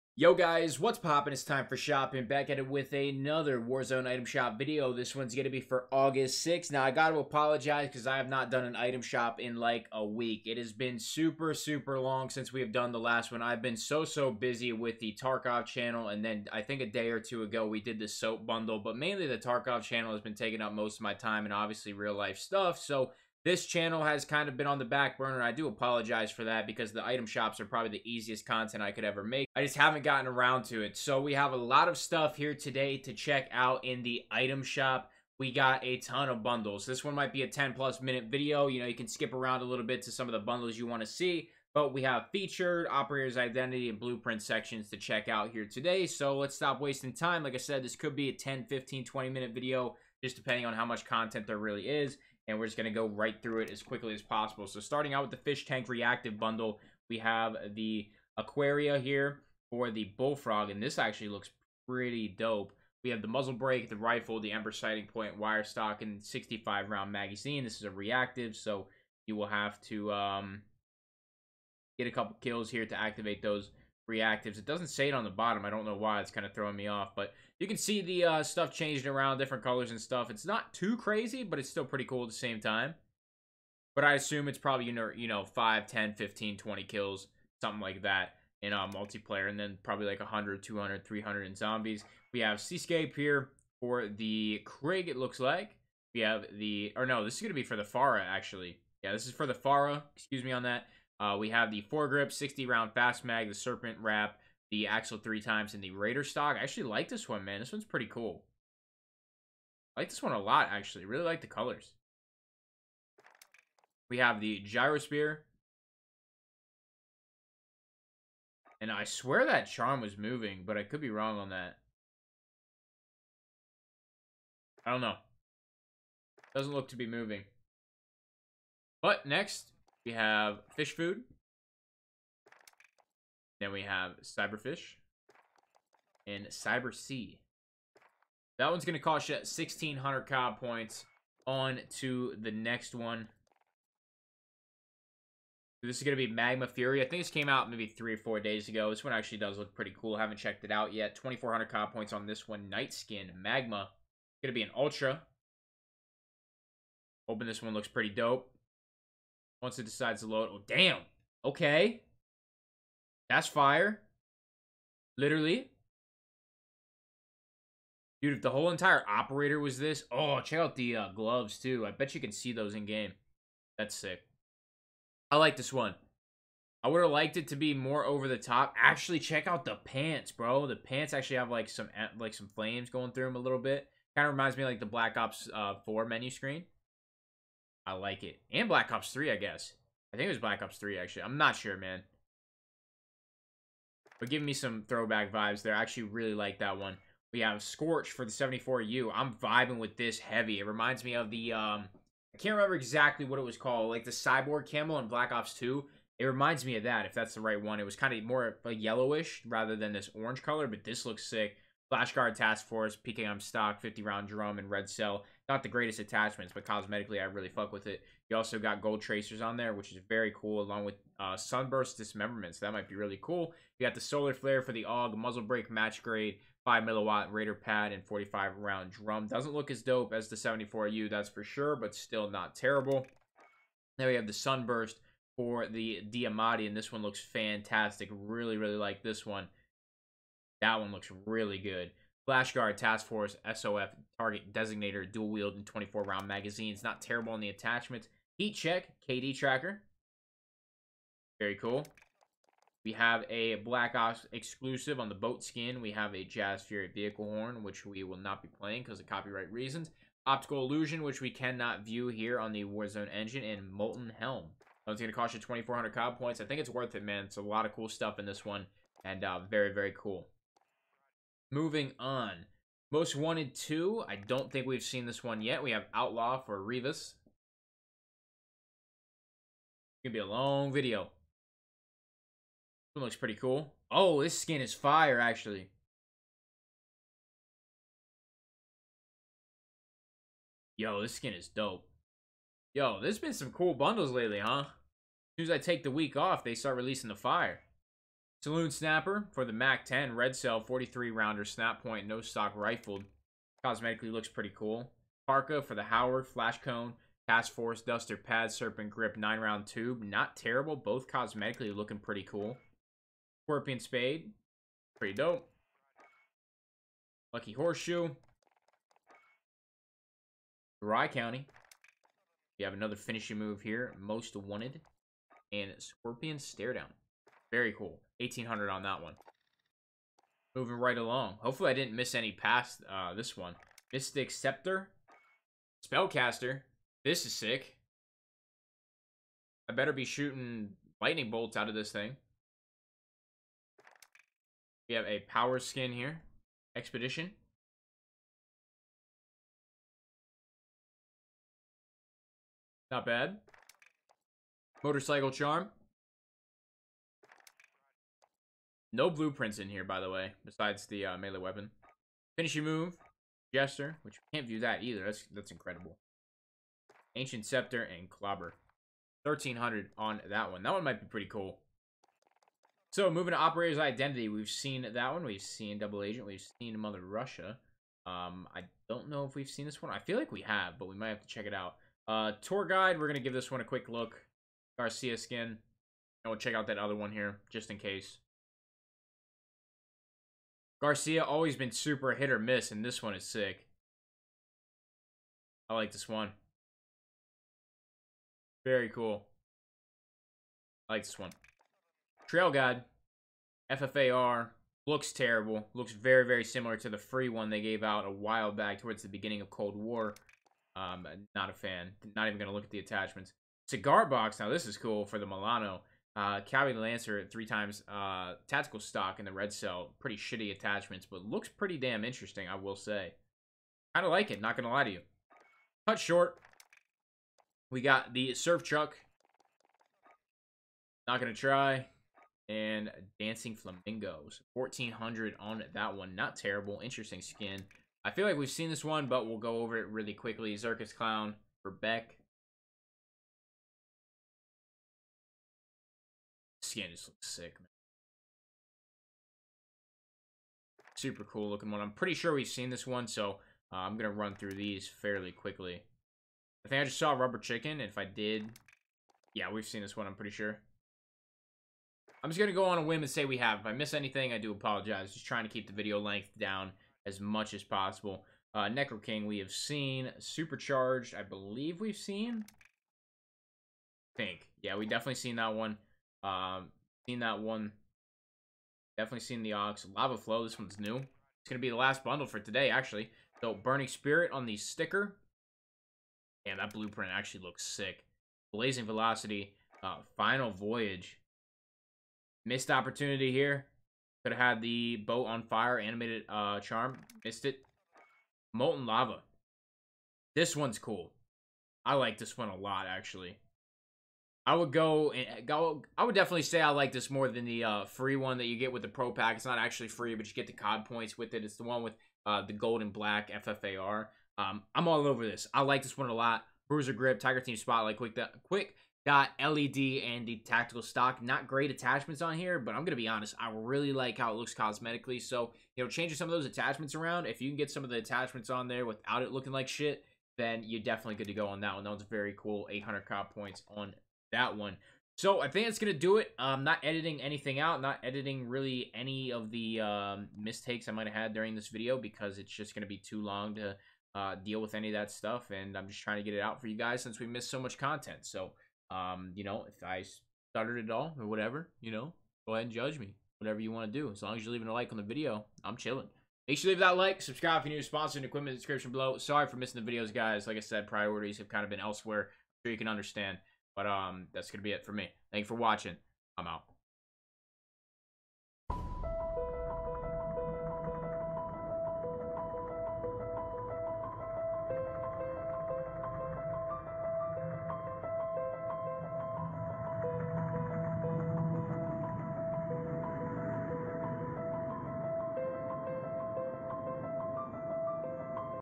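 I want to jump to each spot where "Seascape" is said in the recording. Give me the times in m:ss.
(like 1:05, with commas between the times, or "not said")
1:32.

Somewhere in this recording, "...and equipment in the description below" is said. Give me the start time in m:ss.
9:18.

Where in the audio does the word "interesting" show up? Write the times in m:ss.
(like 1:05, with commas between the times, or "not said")
7:02, 7:16.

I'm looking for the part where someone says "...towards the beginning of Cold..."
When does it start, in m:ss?
6:48.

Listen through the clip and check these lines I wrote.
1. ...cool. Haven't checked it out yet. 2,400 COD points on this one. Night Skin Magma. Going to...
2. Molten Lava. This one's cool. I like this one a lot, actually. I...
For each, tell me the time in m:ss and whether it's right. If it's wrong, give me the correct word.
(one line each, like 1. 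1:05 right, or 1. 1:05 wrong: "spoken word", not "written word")
1. 2:29 right
2. 8:18 right.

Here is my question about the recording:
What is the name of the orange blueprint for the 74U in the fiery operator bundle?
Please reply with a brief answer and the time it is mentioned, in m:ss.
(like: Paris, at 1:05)
Scorch, at 3:17.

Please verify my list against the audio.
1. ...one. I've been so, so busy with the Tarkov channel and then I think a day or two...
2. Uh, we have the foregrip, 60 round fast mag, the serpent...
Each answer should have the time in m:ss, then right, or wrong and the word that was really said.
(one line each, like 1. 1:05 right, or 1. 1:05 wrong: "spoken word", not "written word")
1. 0:13 right
2. 1:41 right.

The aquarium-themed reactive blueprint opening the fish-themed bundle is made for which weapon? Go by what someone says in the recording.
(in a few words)
Bullfrog.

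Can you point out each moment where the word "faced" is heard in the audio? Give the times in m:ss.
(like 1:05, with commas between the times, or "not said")
not said.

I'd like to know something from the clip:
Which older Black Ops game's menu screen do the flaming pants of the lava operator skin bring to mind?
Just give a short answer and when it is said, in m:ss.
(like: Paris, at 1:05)
Black Ops 4, at 3:04.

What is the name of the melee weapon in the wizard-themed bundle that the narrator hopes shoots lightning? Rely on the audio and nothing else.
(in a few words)
Mystic Scepter.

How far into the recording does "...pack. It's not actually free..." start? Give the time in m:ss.
8:29.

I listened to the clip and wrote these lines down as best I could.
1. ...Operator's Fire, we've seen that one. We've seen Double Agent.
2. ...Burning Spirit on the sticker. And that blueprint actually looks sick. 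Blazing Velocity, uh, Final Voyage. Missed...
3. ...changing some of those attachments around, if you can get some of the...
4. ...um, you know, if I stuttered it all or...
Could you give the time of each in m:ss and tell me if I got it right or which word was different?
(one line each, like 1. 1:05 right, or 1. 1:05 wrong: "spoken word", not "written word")
1. 6:13 wrong: "Identity", not "Fire"
2. 8:03 right
3. 8:45 right
4. 9:08 right.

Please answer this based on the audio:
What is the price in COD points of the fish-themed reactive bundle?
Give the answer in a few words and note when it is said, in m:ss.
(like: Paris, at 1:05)
1,600, at 2:19.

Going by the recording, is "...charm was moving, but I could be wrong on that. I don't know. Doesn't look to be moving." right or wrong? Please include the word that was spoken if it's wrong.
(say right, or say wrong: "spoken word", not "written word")
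right.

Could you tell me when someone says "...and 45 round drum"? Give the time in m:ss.
3:47.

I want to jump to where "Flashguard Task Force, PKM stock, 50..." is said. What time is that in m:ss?
3:31.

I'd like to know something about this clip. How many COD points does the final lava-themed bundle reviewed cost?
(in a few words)
800.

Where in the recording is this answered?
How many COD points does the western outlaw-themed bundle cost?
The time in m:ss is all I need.
5:28.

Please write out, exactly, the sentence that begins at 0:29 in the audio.
I just haven't gotten around to it.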